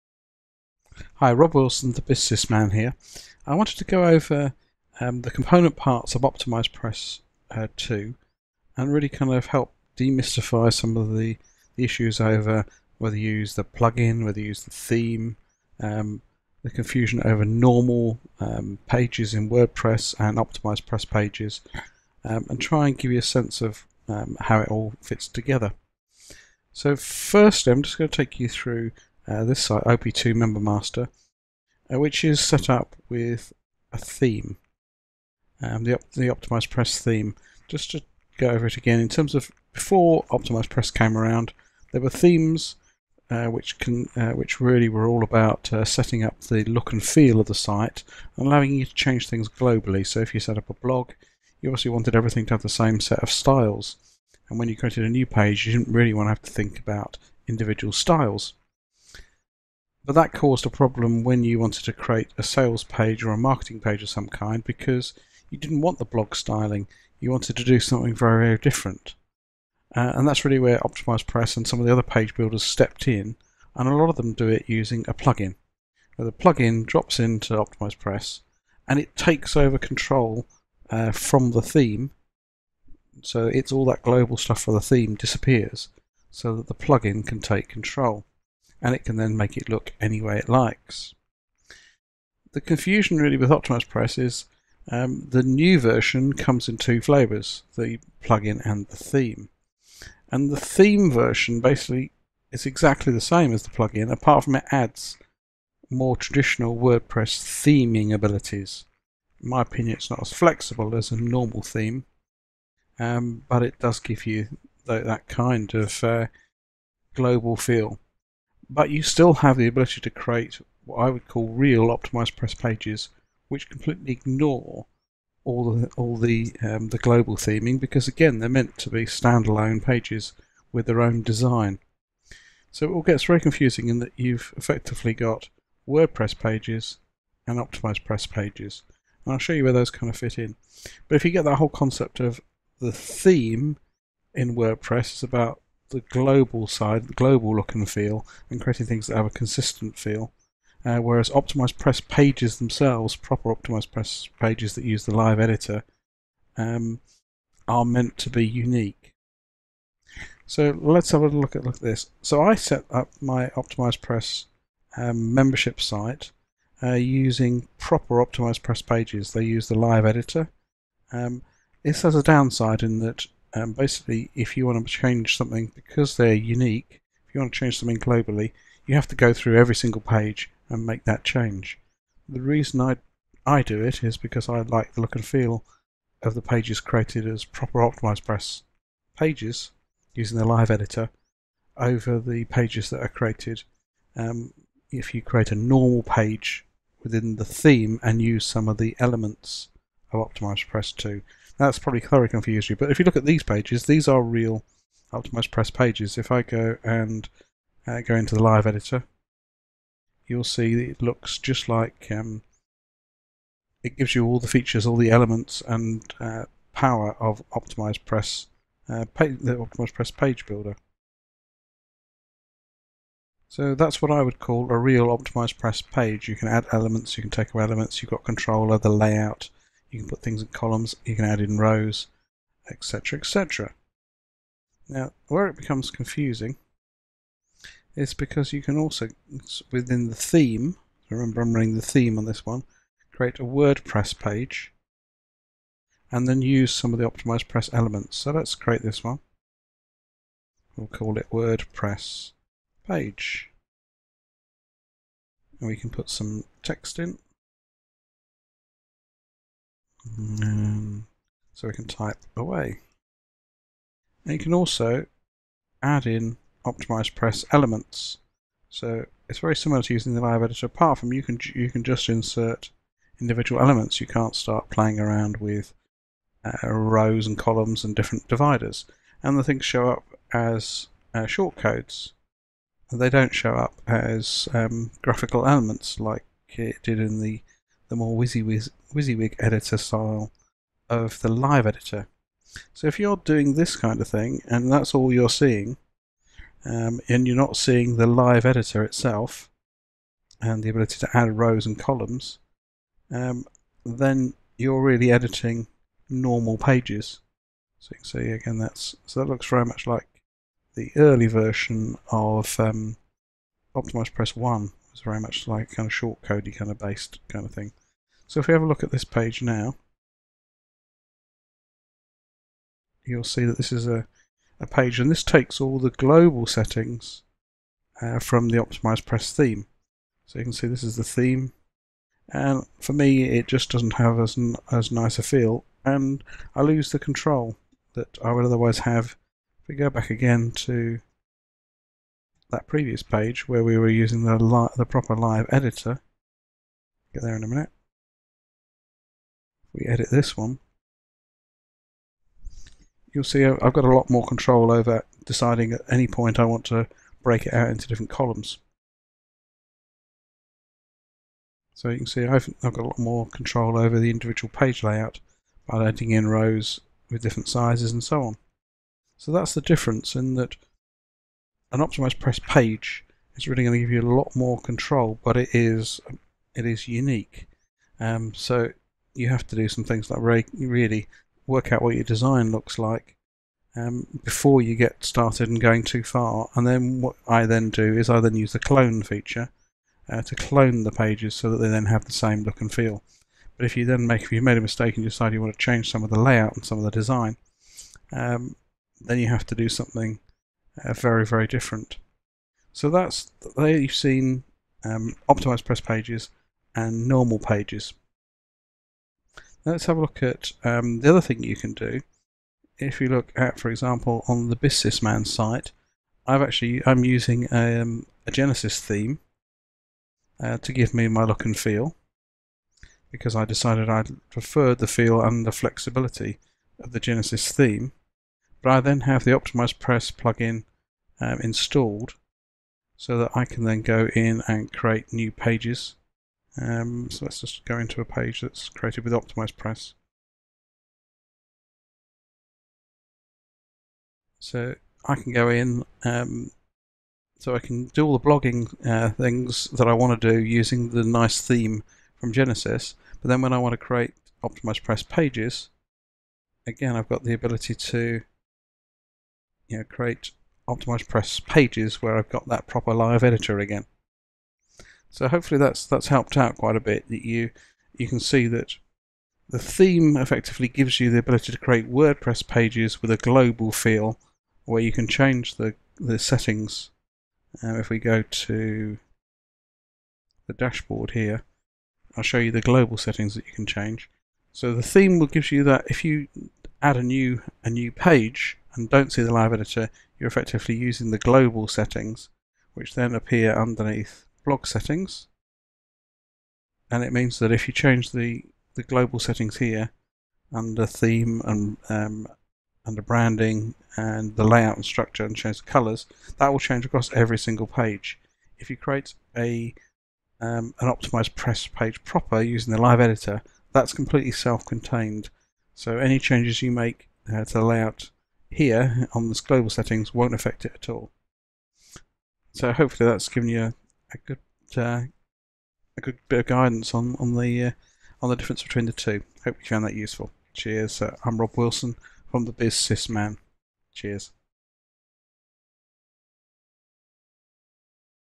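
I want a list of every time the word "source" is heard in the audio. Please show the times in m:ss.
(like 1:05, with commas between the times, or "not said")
not said.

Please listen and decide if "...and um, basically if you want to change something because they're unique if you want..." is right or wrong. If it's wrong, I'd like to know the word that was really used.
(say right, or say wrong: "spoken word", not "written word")
right.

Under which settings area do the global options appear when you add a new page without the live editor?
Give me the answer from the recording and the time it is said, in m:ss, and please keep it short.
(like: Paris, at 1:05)
blog settings, at 8:14.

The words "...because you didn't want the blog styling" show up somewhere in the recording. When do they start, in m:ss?
1:04.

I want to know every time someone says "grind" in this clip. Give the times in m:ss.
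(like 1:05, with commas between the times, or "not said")
not said.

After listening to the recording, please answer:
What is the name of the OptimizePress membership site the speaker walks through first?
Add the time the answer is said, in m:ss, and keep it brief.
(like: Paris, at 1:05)
OP2 Member Master, at 0:29.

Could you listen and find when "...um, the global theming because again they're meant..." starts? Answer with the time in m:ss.
2:06.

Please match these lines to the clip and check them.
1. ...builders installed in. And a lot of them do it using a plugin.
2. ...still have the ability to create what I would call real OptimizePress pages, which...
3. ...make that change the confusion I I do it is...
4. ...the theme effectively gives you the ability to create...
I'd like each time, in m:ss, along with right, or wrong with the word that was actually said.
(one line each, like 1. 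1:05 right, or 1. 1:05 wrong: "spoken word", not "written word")
1. 1:12 wrong: "stepped", not "installed"
2. 1:59 right
3. 3:00 wrong: "reason", not "confusion"
4. 7:49 right.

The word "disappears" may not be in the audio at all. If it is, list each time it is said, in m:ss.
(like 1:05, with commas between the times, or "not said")
1:25.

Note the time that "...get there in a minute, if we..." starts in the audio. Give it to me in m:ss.
5:47.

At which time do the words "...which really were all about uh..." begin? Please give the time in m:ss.
0:44.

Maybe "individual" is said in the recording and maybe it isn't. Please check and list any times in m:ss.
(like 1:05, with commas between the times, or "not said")
0:57, 4:33, 6:04.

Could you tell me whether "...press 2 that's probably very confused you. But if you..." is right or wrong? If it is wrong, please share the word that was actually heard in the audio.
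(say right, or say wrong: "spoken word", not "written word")
right.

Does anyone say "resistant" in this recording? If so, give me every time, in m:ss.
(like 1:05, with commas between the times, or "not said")
not said.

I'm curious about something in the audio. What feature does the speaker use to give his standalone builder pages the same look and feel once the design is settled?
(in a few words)
clone feature.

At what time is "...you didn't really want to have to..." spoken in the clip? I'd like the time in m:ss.
0:55.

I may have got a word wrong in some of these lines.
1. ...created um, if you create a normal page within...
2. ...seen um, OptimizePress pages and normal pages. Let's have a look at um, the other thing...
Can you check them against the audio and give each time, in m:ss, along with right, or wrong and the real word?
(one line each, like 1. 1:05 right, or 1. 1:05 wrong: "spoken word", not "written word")
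1. 3:13 right
2. 6:43 right.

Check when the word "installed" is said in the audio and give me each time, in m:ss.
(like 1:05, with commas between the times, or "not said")
7:11.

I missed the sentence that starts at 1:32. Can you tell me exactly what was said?
The confusion really with OptimizePress is um, the new version comes in two flavors, the plugin and the theme.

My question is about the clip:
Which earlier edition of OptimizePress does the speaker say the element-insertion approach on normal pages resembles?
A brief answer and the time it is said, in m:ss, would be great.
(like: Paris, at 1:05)
OptimizePress One, at 5:13.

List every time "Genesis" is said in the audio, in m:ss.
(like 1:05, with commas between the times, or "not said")
6:58, 7:06, 7:32.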